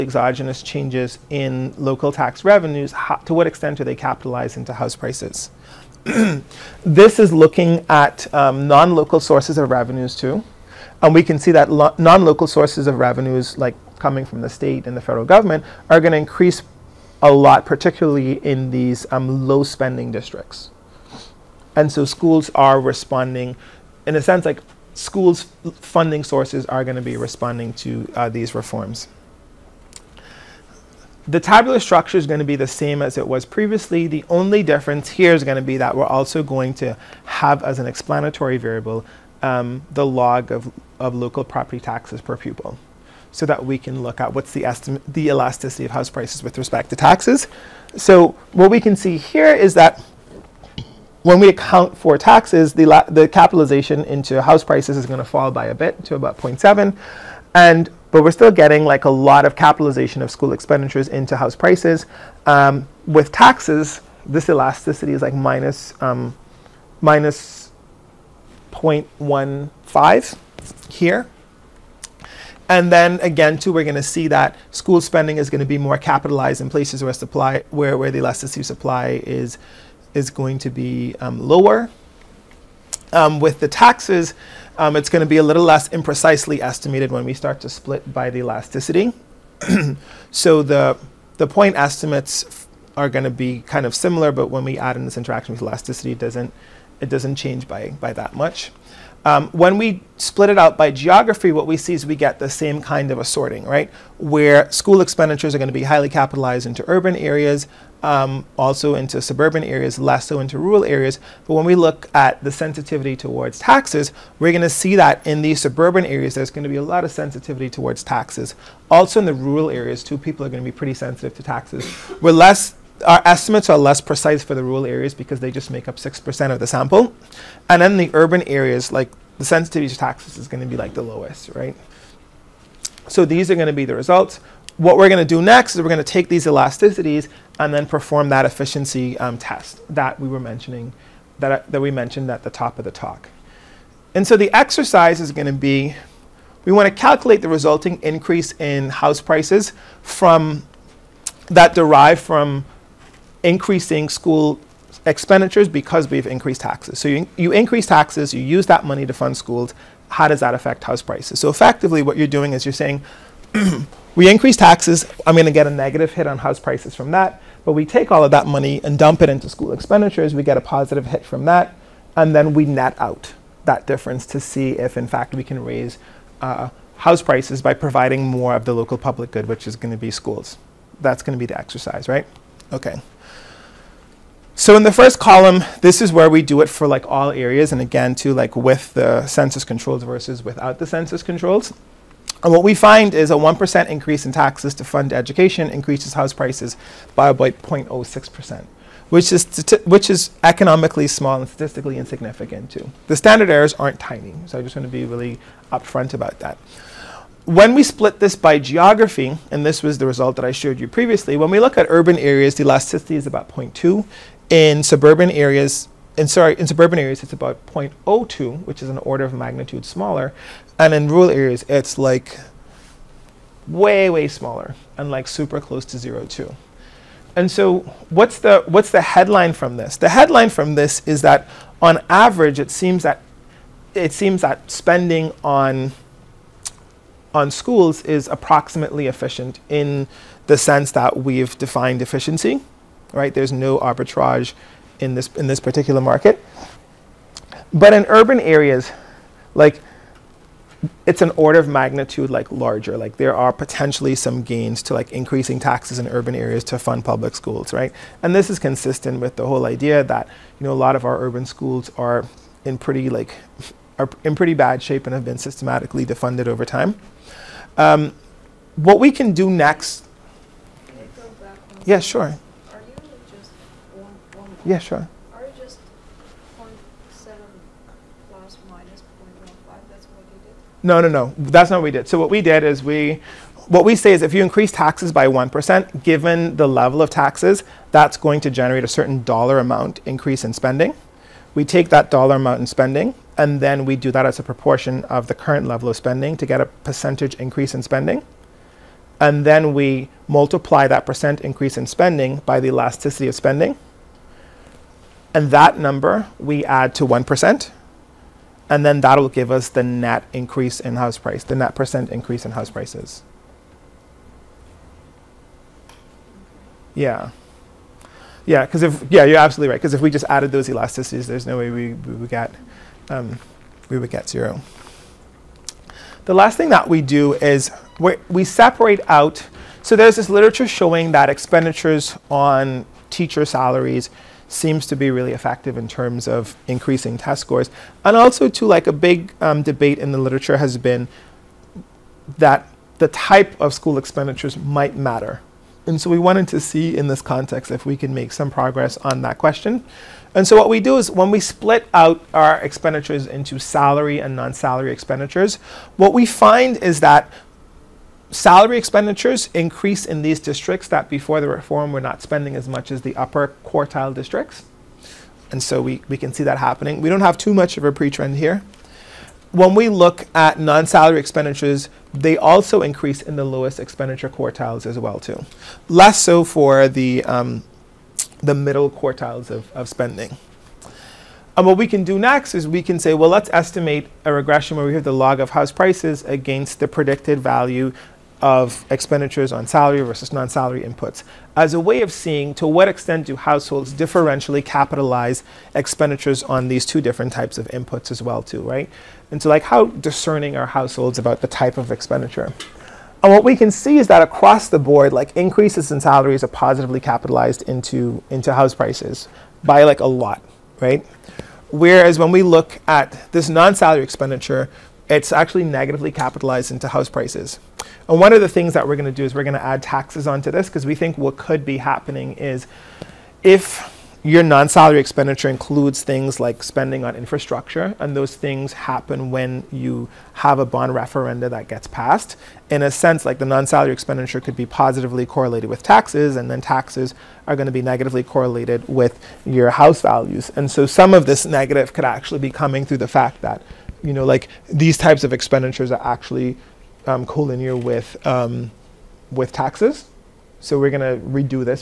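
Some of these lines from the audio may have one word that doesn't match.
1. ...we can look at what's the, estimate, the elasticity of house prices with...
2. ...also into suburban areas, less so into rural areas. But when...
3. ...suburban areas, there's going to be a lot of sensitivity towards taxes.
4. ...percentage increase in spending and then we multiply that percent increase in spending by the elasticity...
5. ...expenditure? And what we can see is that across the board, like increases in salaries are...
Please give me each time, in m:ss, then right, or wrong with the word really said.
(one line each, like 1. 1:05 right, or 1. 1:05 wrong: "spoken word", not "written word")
1. 0:43 right
2. 1:48 right
3. 1:55 right
4. 4:56 right
5. 6:41 right.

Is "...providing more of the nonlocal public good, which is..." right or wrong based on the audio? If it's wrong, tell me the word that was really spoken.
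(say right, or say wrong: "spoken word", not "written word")
wrong: "local", not "nonlocal".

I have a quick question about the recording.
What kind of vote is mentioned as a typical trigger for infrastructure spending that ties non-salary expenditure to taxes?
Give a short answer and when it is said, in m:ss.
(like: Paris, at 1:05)
Bond referenda, at 7:10.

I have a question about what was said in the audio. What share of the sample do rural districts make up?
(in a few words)
6%.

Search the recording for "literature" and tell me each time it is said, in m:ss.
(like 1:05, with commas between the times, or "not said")
5:30, 5:40.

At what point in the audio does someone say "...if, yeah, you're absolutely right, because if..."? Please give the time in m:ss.
5:18.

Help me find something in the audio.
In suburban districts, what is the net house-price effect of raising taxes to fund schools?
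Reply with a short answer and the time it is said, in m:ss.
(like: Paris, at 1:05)
0.02, at 3:37.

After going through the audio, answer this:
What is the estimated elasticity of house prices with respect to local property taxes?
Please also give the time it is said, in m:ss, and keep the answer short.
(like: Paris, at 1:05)
-0.15, at 1:07.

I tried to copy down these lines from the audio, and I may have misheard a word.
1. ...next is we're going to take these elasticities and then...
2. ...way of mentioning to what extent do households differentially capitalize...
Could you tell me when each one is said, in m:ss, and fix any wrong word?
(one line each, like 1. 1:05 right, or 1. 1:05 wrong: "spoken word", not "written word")
1. 2:15 right
2. 6:31 wrong: "seeing", not "mentioning".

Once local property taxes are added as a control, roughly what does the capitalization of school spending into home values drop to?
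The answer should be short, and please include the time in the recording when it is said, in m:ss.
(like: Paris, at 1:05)
0.7, at 0:56.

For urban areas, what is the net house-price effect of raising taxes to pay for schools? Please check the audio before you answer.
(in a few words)
0.2.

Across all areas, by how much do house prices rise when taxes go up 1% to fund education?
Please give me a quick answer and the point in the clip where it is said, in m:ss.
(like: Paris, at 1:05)
0.06%, at 3:17.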